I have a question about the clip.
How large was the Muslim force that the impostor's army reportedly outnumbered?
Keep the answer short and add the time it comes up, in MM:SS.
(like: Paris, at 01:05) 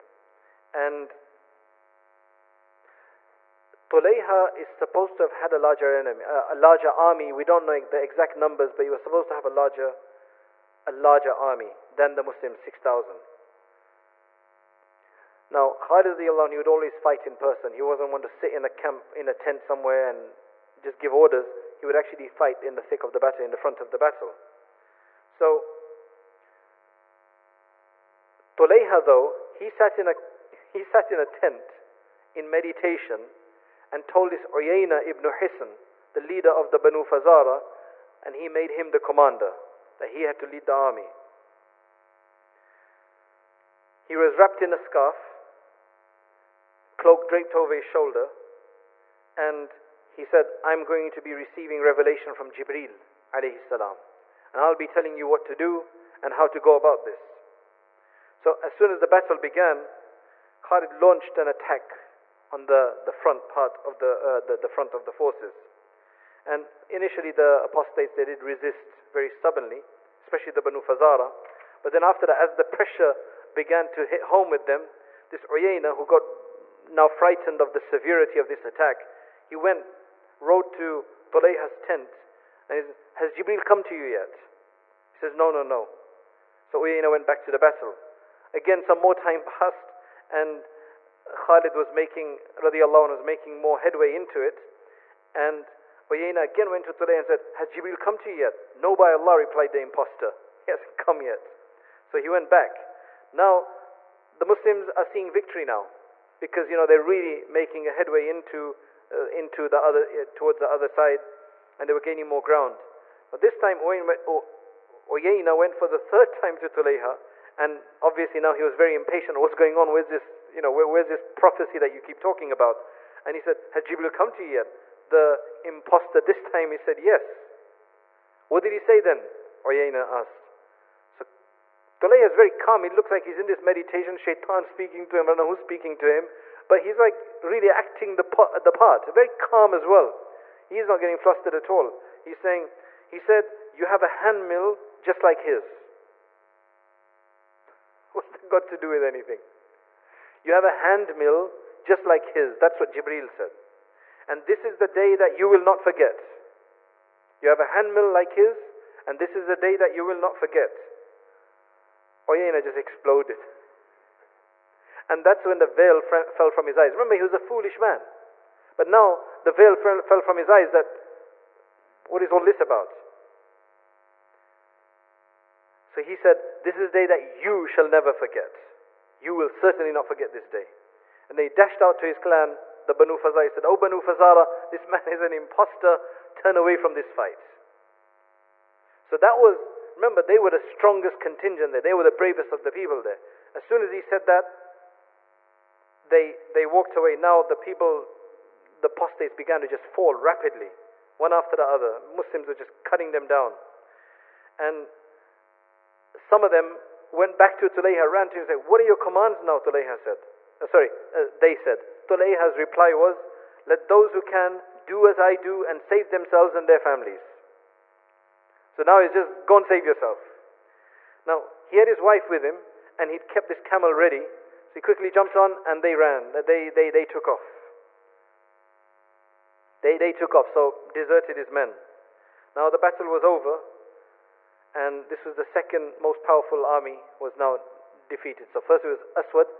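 6000, at 00:12.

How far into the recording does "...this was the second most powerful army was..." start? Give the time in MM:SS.
03:55.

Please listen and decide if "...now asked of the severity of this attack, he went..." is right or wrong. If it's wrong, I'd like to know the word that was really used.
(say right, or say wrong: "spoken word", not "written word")
wrong: "frightened", not "asked".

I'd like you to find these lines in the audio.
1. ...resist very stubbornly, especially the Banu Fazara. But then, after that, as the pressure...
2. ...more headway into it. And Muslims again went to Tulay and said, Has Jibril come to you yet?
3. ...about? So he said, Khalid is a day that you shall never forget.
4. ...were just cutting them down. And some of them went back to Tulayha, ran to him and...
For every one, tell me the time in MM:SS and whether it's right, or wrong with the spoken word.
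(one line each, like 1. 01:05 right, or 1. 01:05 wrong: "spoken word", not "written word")
1. 01:08 right
2. 01:33 wrong: "Uyayna", not "Muslims"
3. 02:52 wrong: "This", not "Khalid"
4. 03:22 right.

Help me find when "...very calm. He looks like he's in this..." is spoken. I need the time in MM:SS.
02:12.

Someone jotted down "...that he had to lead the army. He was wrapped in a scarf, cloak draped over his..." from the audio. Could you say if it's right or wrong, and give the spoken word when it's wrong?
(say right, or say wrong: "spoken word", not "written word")
right.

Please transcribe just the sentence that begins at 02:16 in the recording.
But he's like really acting the, part, the part, very calm as well.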